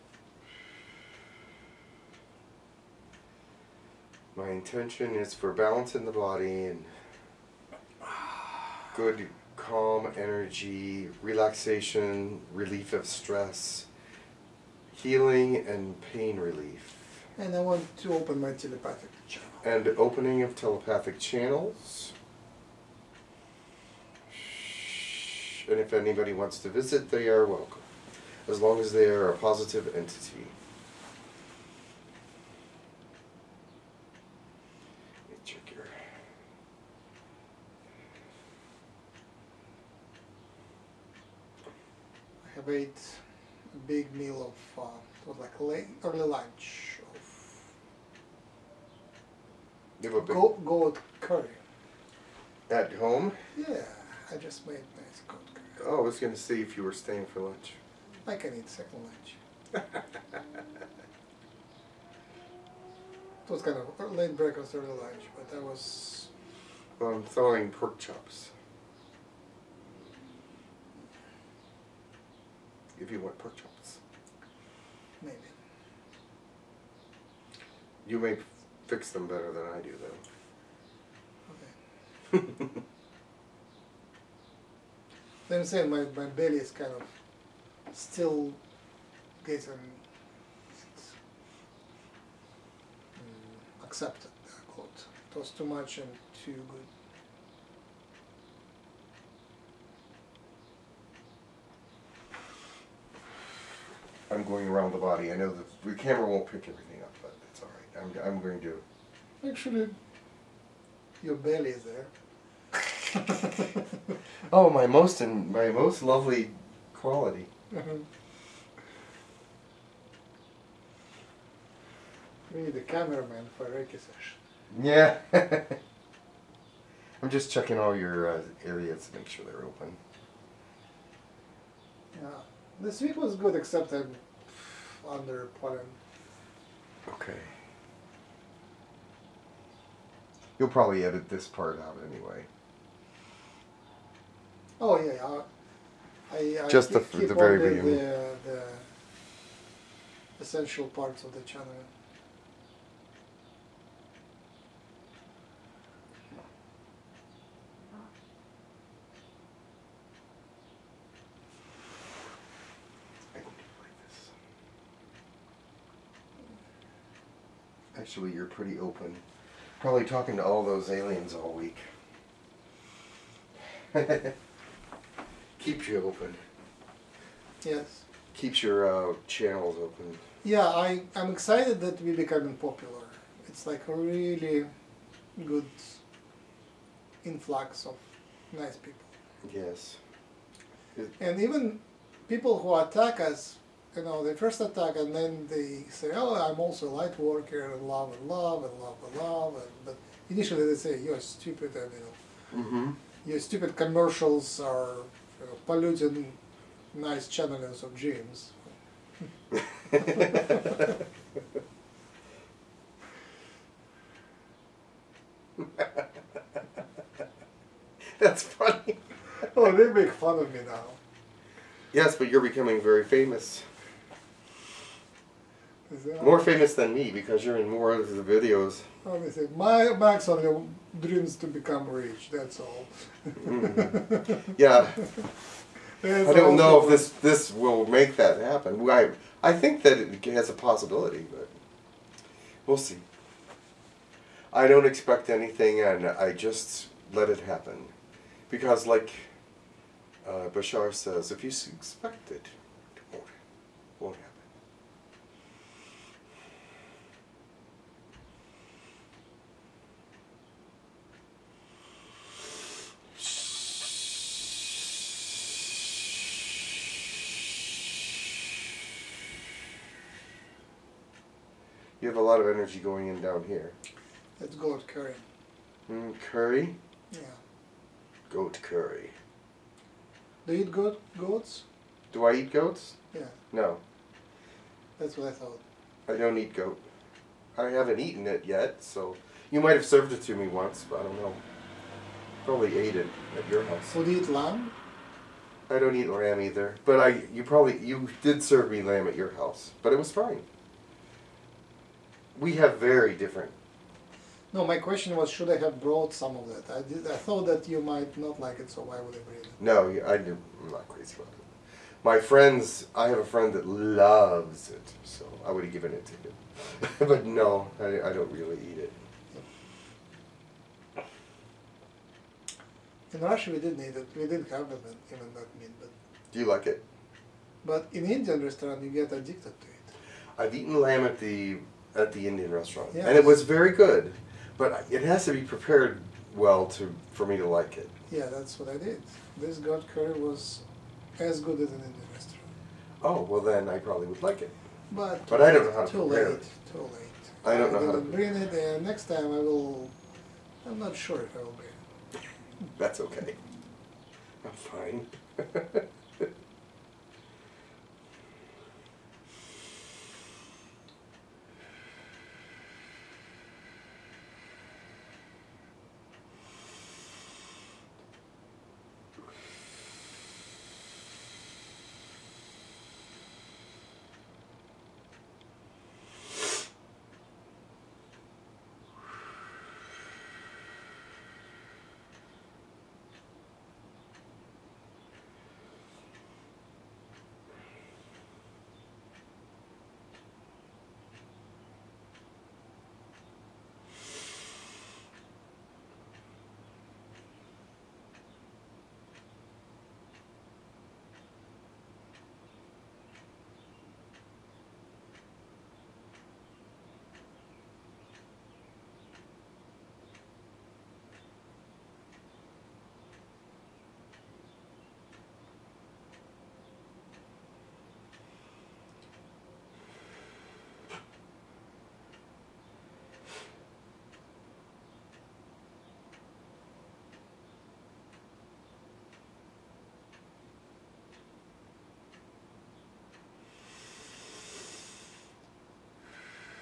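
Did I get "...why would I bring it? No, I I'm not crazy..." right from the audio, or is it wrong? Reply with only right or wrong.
right.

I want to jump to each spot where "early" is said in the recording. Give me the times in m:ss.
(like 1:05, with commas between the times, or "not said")
0:46, 1:04.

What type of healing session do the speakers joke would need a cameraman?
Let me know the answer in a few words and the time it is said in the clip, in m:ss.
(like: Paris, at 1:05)
Reiki, at 2:03.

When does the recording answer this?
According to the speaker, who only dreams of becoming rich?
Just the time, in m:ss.
3:49.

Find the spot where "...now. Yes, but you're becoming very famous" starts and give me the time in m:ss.
3:40.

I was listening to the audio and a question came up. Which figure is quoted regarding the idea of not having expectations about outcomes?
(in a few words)
Bashar.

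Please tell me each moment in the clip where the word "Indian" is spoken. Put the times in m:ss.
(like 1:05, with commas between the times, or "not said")
5:28, 5:32, 5:41.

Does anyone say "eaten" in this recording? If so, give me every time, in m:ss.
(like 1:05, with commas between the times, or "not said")
4:48, 5:30.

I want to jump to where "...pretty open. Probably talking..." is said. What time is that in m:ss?
2:48.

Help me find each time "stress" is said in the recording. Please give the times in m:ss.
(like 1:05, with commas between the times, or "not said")
0:13.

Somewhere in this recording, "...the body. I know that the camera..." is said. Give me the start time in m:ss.
1:44.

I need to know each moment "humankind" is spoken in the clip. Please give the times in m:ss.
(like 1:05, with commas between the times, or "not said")
not said.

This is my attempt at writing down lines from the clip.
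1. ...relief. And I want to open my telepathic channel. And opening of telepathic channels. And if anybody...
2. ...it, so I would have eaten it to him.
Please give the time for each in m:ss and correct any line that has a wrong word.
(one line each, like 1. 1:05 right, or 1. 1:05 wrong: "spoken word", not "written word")
1. 0:16 right
2. 5:14 wrong: "given", not "eaten".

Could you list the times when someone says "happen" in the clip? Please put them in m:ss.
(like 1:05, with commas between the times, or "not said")
3:58, 4:07.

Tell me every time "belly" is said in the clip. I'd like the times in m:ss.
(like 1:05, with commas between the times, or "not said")
1:26, 1:51.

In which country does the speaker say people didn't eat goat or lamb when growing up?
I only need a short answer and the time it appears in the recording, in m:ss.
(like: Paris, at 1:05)
Russia, at 5:23.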